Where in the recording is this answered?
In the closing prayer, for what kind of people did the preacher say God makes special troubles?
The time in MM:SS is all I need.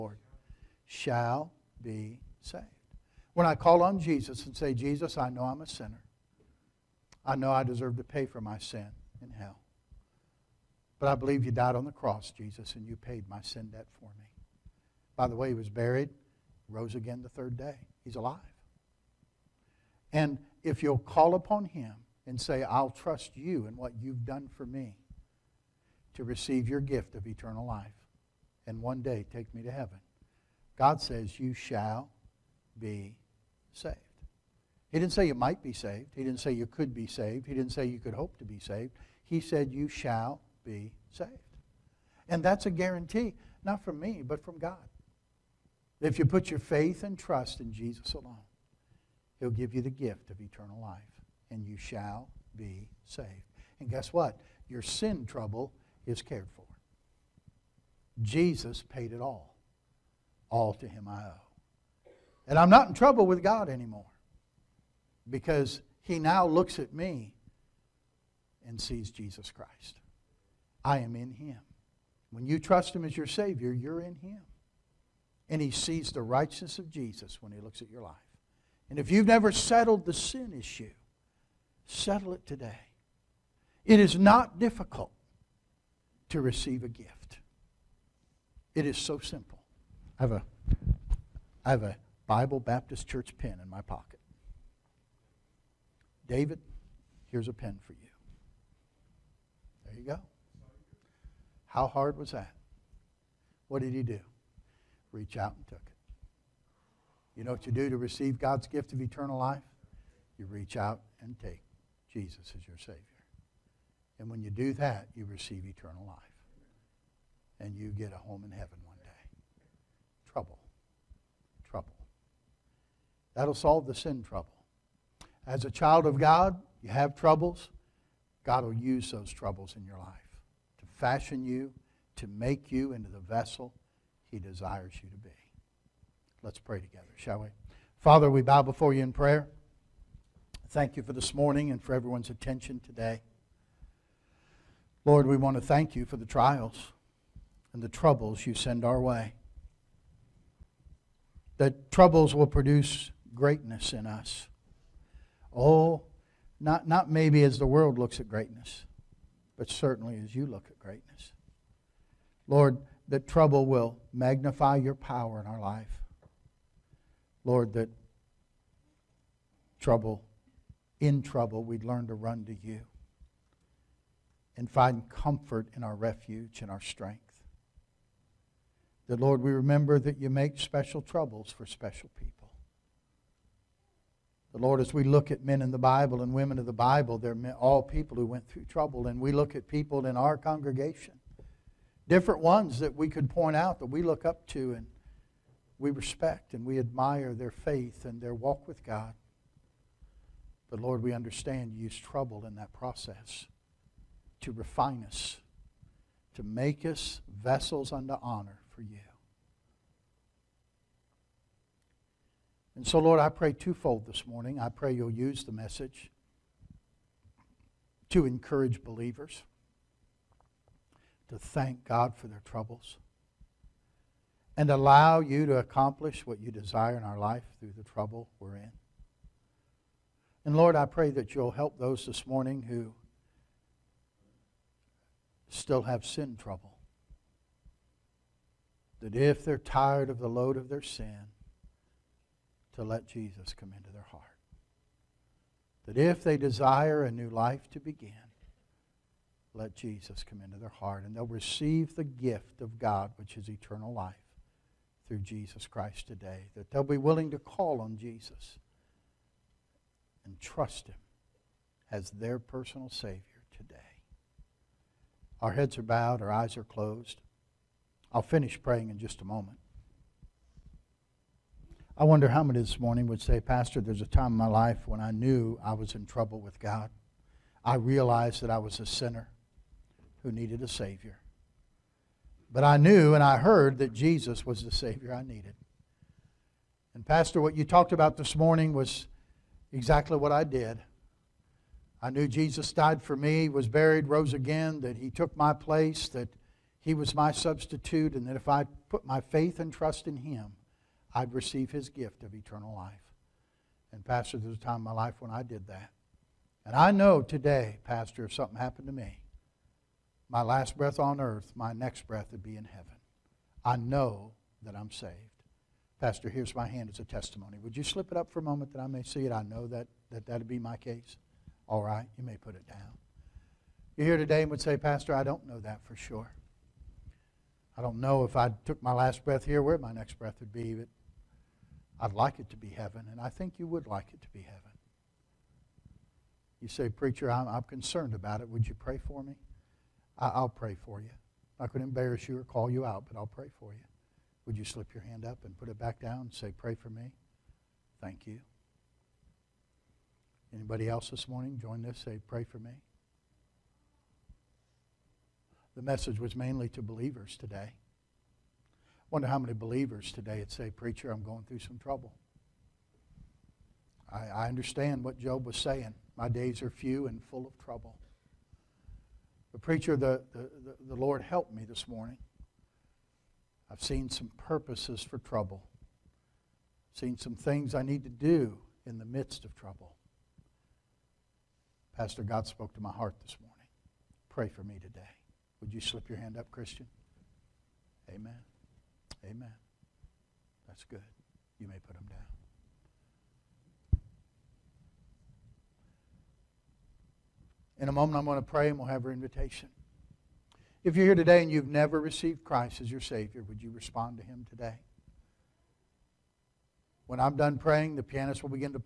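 03:01.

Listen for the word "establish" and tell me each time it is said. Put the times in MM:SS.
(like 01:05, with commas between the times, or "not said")
not said.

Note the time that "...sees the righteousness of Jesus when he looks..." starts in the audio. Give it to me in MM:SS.
01:15.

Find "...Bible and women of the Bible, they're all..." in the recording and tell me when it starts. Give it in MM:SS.
03:05.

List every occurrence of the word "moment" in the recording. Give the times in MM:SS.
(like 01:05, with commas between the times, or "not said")
04:29, 05:18, 06:37.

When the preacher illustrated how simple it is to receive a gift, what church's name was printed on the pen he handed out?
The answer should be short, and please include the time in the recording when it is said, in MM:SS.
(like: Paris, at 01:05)
Bible Baptist Church, at 01:32.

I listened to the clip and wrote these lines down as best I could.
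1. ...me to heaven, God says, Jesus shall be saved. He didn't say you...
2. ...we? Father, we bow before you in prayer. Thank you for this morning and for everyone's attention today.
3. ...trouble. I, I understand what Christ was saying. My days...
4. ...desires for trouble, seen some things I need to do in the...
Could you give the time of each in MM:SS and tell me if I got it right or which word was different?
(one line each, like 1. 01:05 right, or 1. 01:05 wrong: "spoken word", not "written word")
1. 00:29 wrong: "You", not "Jesus"
2. 02:17 right
3. 06:01 wrong: "Job", not "Christ"
4. 06:14 wrong: "purposes", not "desires".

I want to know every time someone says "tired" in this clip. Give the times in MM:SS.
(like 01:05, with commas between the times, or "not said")
03:59.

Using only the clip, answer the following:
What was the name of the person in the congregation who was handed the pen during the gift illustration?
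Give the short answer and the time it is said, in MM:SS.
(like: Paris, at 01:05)
David, at 01:36.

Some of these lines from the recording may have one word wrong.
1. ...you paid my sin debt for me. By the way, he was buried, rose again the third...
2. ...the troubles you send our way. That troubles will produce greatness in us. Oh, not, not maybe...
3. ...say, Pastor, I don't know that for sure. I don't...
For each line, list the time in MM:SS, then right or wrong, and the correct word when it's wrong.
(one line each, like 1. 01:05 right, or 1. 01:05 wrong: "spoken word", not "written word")
1. 00:12 right
2. 02:27 right
3. 05:24 right.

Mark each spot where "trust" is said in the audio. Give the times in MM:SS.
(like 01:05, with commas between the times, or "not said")
00:22, 00:47, 01:12, 04:20, 04:59.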